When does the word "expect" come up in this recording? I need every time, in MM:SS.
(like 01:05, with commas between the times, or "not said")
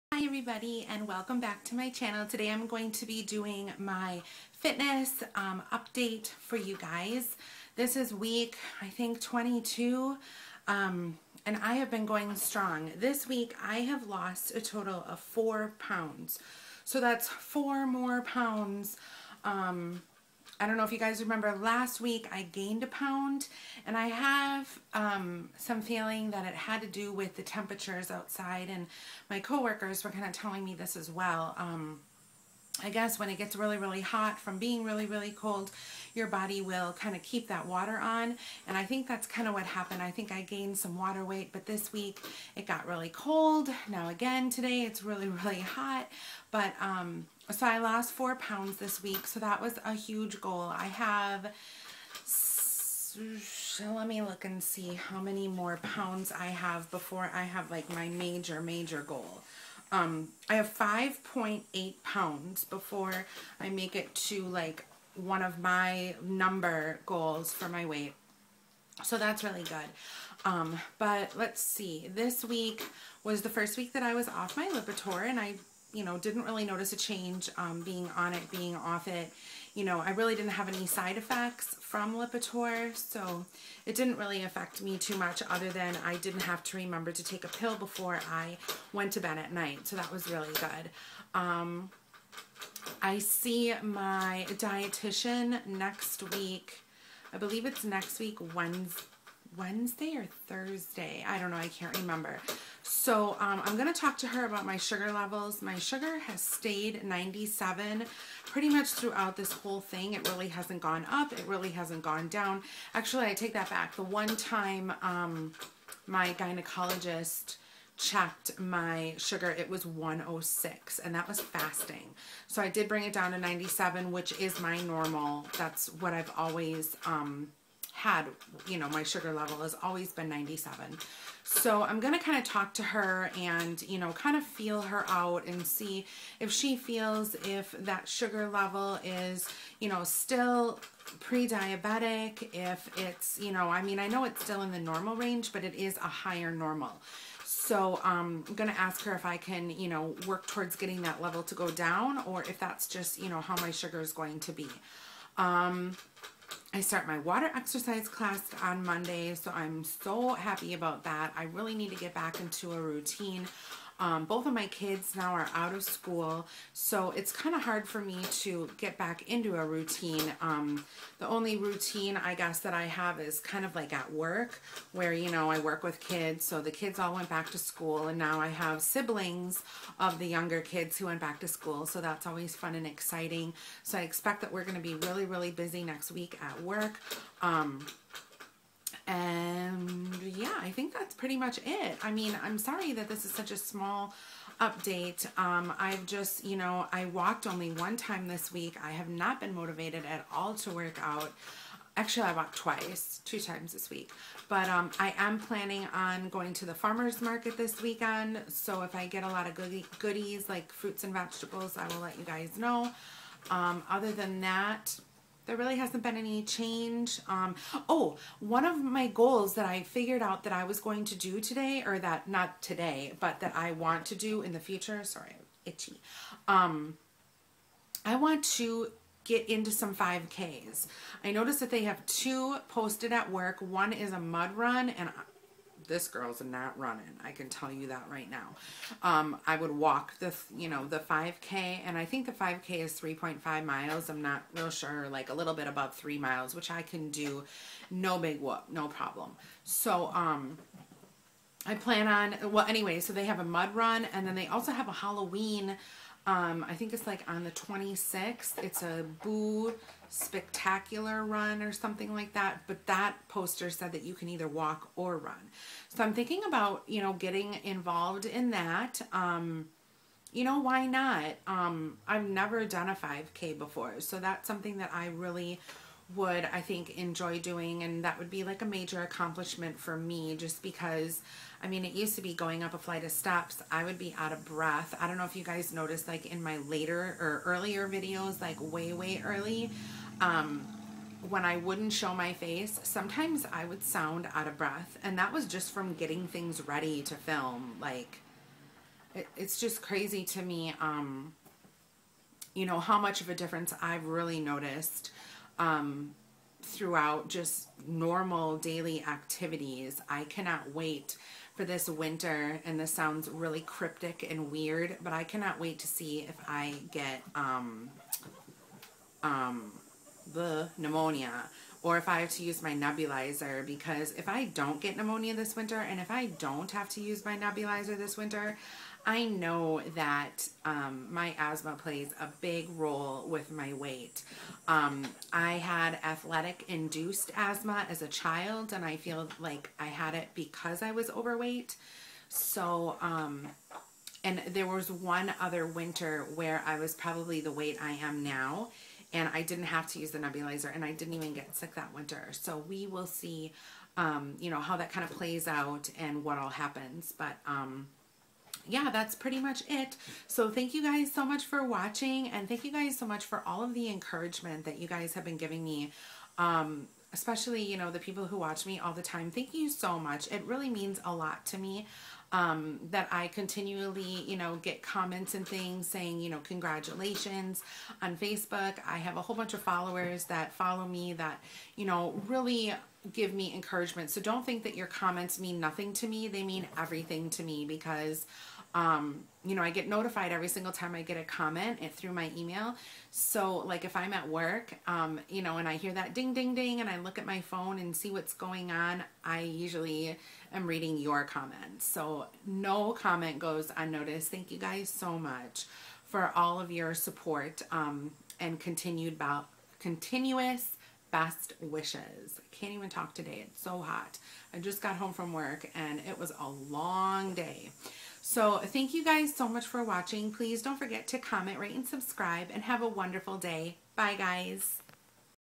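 03:04.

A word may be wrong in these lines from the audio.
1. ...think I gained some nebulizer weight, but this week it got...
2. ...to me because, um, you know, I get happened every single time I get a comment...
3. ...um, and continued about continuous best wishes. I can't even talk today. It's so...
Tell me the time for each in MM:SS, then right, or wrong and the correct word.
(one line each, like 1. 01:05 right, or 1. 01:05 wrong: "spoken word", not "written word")
1. 00:40 wrong: "water", not "nebulizer"
2. 06:27 wrong: "notified", not "happened"
3. 06:47 right.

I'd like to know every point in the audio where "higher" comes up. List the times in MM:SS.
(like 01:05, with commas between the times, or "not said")
02:26.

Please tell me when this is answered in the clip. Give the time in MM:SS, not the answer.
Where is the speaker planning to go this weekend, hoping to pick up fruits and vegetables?
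03:26.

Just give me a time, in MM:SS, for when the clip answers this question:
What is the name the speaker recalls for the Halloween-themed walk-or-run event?
04:19.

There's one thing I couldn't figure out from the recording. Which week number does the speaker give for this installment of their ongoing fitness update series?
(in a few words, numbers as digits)
22.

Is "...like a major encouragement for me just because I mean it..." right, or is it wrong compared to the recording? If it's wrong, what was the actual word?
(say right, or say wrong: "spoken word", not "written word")
wrong: "accomplishment", not "encouragement".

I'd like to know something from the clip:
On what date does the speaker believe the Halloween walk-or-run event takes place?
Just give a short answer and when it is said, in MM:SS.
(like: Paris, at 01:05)
26th, at 04:17.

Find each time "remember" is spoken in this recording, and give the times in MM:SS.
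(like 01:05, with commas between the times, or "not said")
00:21, 01:26, 01:41.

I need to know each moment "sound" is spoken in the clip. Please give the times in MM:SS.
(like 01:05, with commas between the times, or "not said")
04:53, 05:12.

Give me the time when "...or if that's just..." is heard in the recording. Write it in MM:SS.
02:32.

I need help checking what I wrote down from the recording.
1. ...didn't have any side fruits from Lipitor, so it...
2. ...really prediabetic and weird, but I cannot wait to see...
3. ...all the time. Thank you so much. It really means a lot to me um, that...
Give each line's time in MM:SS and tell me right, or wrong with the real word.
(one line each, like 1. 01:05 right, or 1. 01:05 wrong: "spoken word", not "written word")
1. 01:20 wrong: "effects", not "fruits"
2. 05:13 wrong: "cryptic", not "prediabetic"
3. 06:08 right.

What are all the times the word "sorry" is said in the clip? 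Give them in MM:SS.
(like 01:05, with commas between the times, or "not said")
03:12, 03:45.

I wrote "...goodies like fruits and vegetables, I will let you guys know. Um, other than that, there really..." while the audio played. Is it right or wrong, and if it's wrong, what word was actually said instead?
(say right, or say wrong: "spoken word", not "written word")
right.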